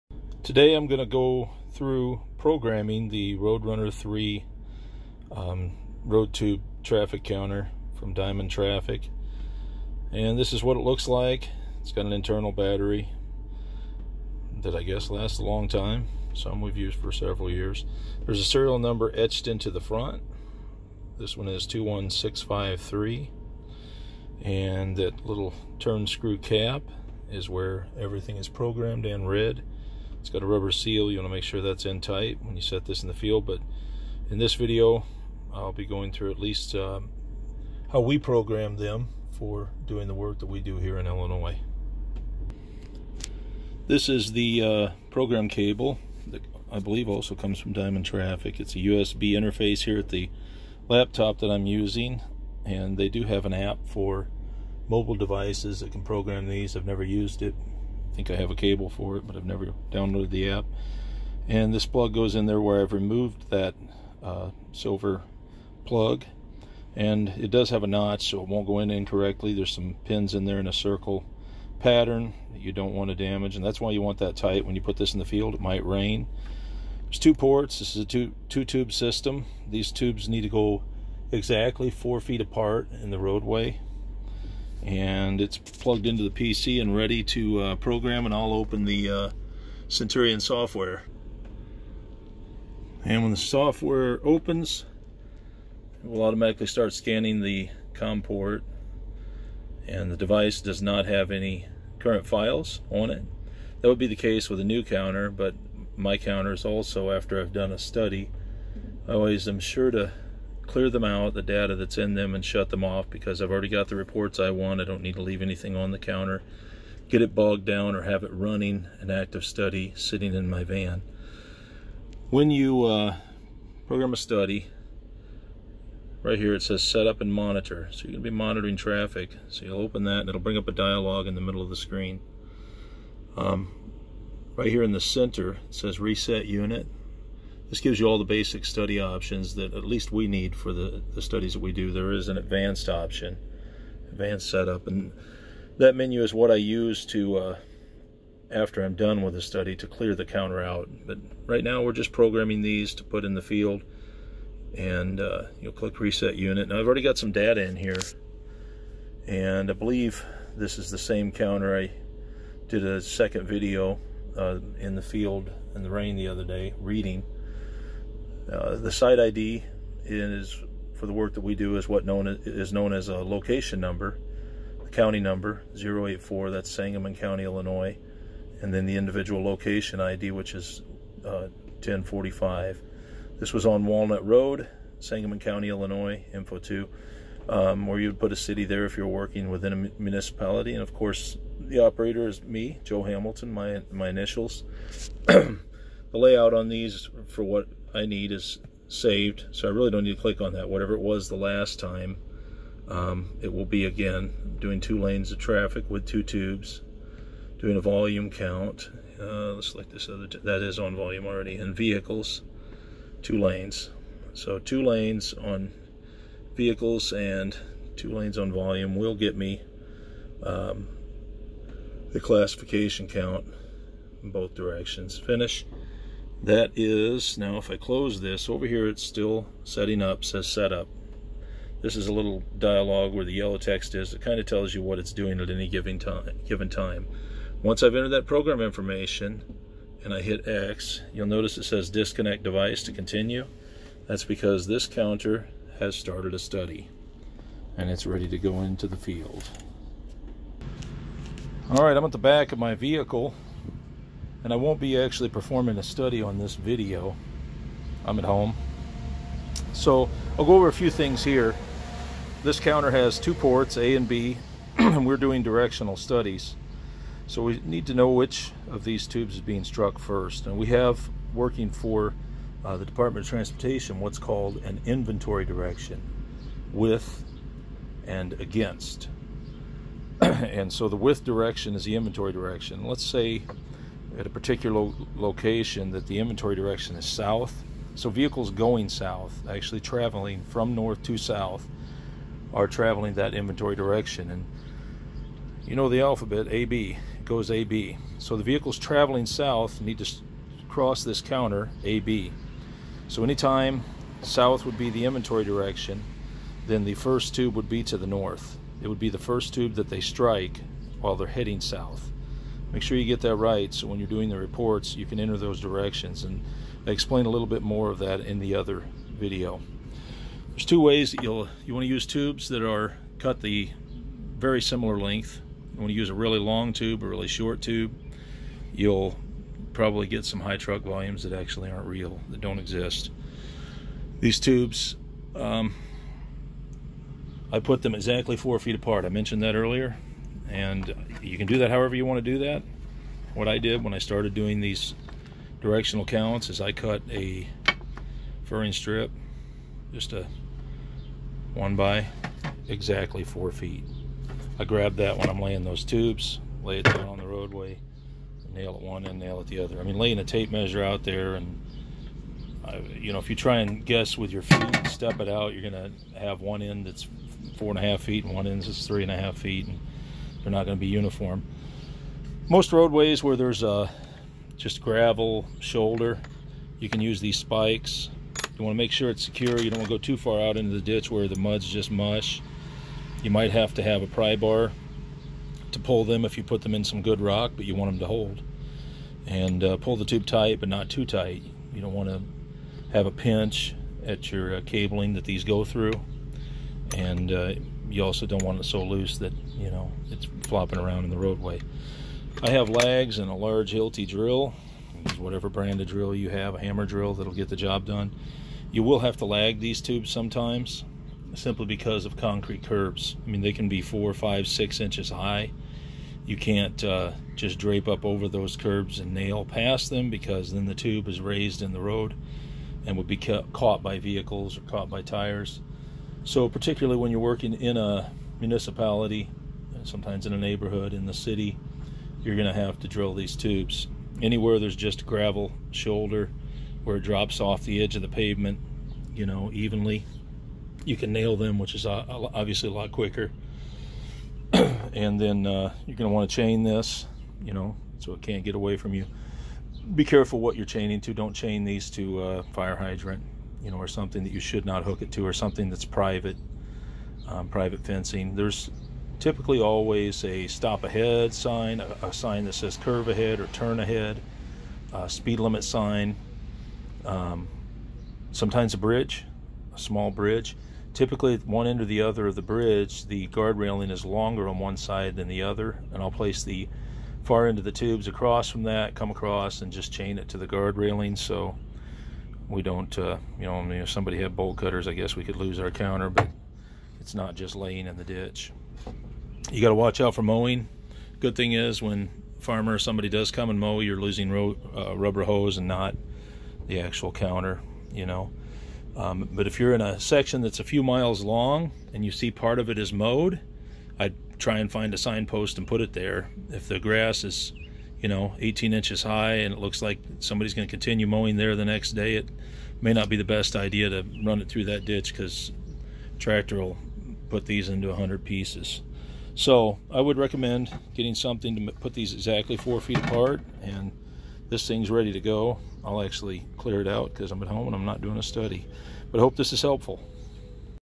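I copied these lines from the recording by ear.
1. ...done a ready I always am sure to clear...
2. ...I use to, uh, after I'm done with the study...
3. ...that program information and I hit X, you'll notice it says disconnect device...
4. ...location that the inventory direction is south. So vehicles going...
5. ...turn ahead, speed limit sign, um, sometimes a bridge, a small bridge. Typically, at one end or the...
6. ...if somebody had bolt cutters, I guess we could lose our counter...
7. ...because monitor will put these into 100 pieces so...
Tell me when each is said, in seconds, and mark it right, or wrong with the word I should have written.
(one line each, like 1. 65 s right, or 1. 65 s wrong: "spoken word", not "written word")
1. 107 s wrong: "study", not "ready"
2. 146 s right
3. 238 s right
4. 285 s right
5. 463 s right
6. 483 s right
7. 515 s wrong: "tractor", not "monitor".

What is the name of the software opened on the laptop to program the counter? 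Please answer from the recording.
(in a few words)
Centurion.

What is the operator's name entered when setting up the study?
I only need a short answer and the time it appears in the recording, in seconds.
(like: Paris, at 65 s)
Joe Hamilton, at 192 s.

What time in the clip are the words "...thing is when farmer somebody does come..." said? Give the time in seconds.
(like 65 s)
491 s.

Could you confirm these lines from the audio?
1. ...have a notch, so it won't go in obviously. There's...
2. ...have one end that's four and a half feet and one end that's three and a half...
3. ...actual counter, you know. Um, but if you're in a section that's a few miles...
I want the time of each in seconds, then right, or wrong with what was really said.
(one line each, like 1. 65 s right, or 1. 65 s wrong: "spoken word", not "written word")
1. 67 s wrong: "incorrectly", not "obviously"
2. 366 s right
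3. 496 s right.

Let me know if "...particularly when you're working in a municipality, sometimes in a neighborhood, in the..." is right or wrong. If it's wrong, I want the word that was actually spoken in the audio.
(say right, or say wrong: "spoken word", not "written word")
right.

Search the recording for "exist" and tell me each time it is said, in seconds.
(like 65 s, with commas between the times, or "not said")
332 s.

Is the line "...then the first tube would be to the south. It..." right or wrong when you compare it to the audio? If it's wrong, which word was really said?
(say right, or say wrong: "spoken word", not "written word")
wrong: "north", not "south".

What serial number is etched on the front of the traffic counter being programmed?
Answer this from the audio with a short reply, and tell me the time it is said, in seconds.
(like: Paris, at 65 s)
21653, at 21 s.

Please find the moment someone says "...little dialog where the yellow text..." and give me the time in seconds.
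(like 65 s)
232 s.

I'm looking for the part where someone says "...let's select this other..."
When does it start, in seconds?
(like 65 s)
209 s.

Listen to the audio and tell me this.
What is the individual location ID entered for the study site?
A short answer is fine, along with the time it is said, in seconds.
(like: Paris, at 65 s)
1045, at 181 s.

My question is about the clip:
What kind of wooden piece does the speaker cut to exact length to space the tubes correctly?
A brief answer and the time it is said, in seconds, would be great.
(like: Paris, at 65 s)
furring strip, at 348 s.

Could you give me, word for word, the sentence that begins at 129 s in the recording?
So you'll open that and it'll bring up a dialog in the middle of the screen.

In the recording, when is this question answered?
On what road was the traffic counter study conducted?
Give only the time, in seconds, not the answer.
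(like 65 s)
183 s.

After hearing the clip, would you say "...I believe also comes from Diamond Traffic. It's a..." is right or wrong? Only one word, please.
right.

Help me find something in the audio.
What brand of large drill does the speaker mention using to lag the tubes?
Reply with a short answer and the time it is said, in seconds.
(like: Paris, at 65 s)
Hilti, at 403 s.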